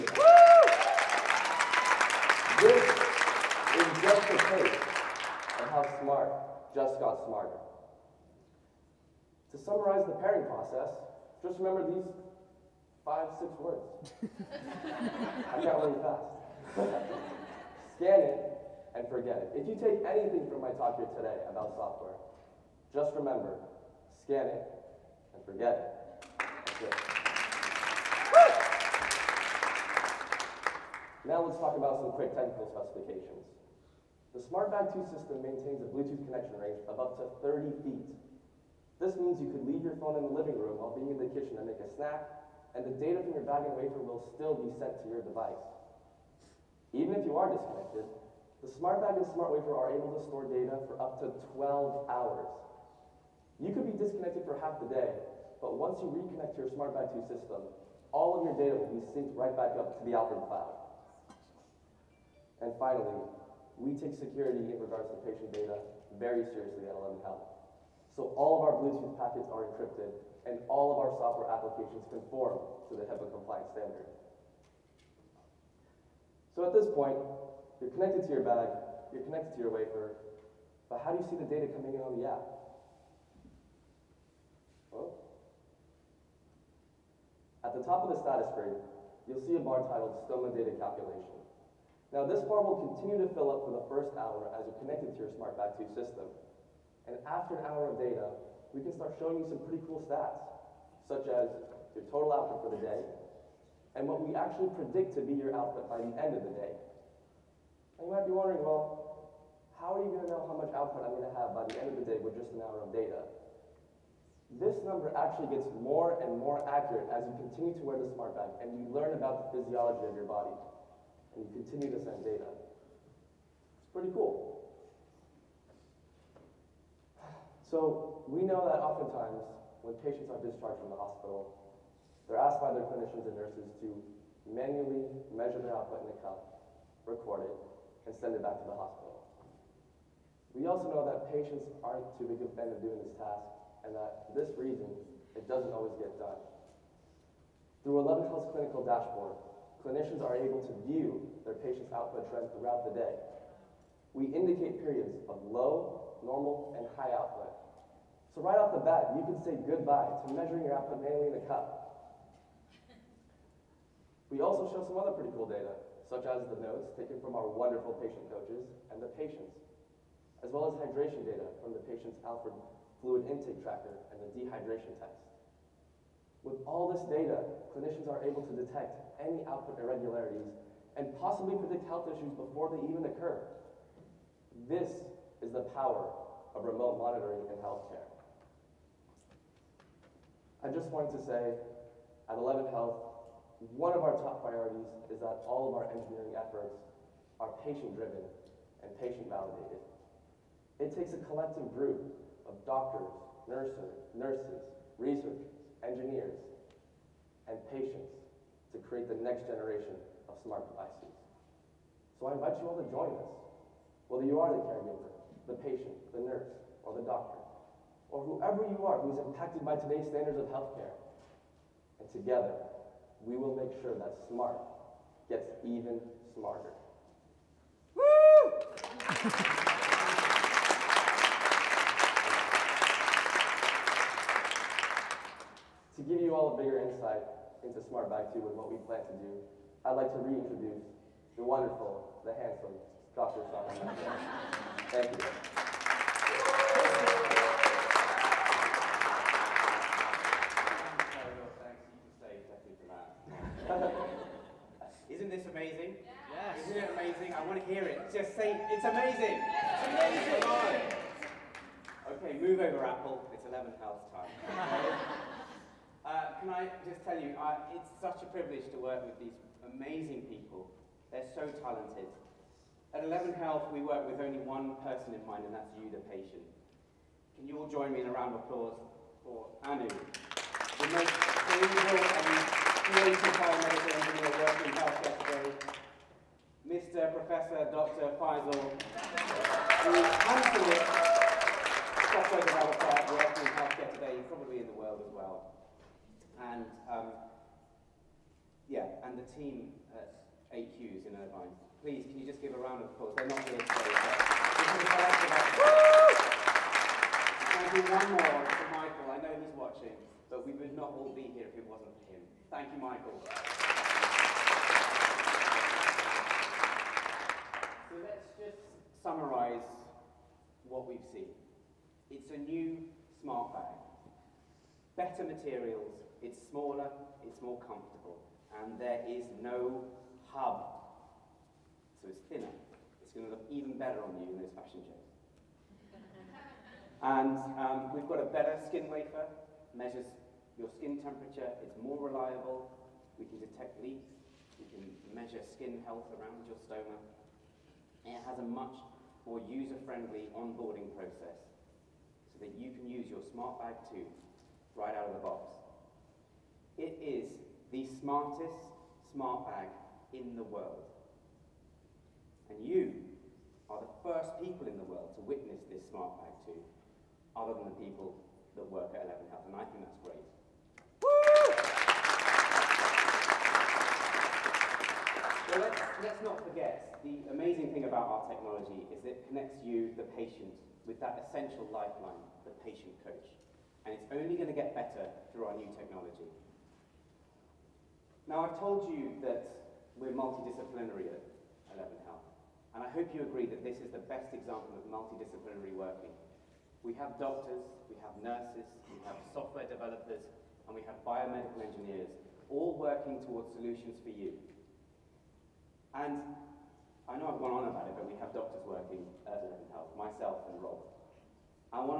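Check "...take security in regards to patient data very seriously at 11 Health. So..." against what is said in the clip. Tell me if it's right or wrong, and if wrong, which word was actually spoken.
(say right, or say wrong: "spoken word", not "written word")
right.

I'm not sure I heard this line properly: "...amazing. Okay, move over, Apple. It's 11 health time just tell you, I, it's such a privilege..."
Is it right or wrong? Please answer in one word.
right.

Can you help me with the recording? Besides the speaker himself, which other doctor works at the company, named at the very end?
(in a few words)
Rob.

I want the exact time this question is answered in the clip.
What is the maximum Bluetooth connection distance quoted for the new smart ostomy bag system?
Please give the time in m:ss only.
0:37.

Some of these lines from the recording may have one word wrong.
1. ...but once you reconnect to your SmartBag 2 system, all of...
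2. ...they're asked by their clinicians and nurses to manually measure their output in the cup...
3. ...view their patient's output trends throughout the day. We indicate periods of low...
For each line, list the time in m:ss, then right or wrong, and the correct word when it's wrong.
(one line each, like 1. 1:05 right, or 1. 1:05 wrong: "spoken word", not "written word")
1. 0:55 right
2. 2:12 right
3. 2:30 right.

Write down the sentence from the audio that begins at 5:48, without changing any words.
It has a much more user-friendly onboarding process so that you can use your Smart Bag 2 right out of the box.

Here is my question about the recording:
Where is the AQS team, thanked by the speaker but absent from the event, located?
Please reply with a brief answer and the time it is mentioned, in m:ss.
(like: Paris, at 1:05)
Irvine, at 5:01.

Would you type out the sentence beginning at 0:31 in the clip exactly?
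Now let's talk about some quick technical specifications.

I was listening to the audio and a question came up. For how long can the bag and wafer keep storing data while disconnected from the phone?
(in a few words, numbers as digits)
12 hours.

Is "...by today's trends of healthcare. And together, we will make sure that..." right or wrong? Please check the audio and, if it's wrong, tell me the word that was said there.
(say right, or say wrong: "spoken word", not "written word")
wrong: "standards", not "trends".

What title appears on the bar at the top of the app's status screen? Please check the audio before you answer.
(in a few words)
Stoma Data Calculation.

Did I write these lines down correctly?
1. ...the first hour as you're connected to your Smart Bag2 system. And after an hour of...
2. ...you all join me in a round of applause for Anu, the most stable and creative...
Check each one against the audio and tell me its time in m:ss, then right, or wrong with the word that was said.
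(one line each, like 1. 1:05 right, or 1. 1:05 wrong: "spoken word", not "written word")
1. 1:33 right
2. 4:37 right.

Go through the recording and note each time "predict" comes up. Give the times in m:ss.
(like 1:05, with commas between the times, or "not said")
1:44, 3:01.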